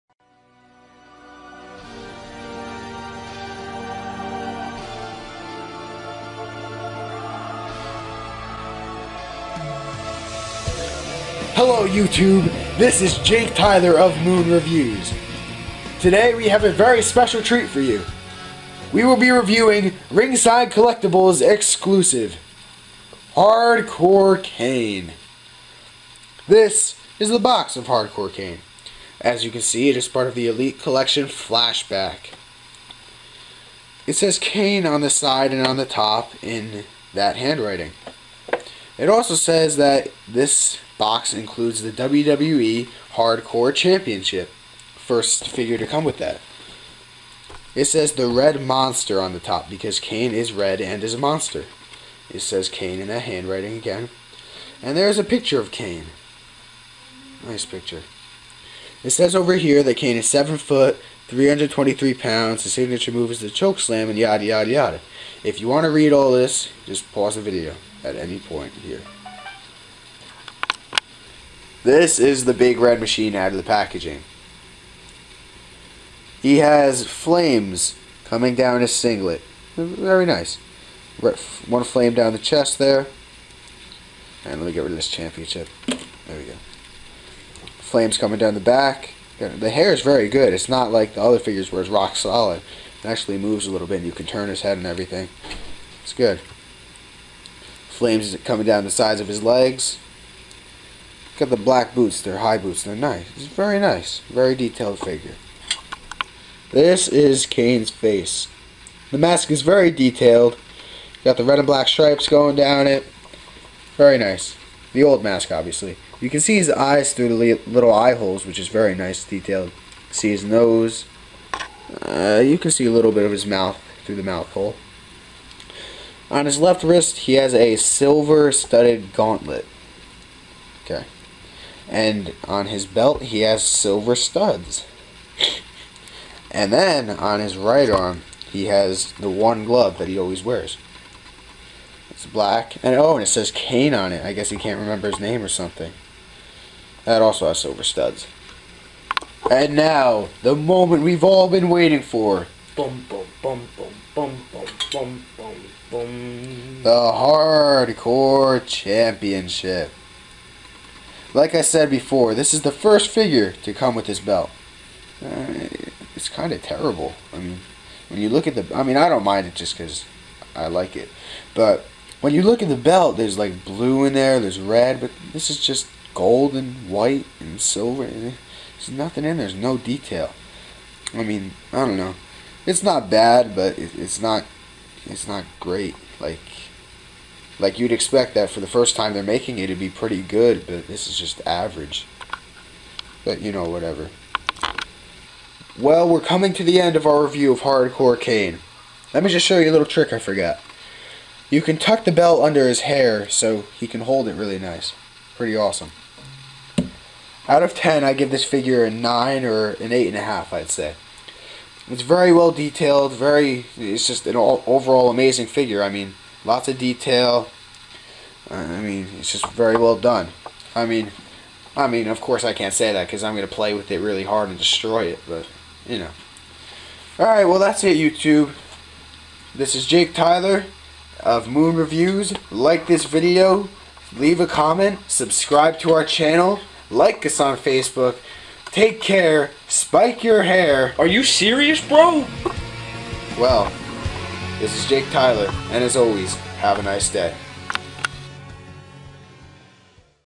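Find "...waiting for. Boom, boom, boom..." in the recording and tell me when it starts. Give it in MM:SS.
02:31.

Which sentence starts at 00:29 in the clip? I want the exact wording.
As you can see, it is part of the Elite Collection Flashback.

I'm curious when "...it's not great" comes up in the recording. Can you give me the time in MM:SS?
03:05.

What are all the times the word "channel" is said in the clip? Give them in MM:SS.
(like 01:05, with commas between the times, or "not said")
03:56.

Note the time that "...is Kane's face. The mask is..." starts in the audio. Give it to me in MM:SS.
01:47.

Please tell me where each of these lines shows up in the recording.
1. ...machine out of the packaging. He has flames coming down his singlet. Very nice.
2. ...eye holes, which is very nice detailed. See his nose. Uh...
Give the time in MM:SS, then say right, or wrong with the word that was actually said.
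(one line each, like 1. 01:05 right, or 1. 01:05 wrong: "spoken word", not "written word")
1. 01:12 right
2. 01:57 right.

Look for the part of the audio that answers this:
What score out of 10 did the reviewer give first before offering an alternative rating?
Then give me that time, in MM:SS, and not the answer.
03:28.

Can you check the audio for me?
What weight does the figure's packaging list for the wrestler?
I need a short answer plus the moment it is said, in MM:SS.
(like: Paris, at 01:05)
323 pounds, at 01:01.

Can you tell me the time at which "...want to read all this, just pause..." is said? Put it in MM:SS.
01:05.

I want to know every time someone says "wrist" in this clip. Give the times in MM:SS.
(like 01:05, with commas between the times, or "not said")
02:06.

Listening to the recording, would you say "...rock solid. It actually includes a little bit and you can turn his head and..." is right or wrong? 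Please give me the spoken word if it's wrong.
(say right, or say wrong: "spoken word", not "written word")
wrong: "moves", not "includes".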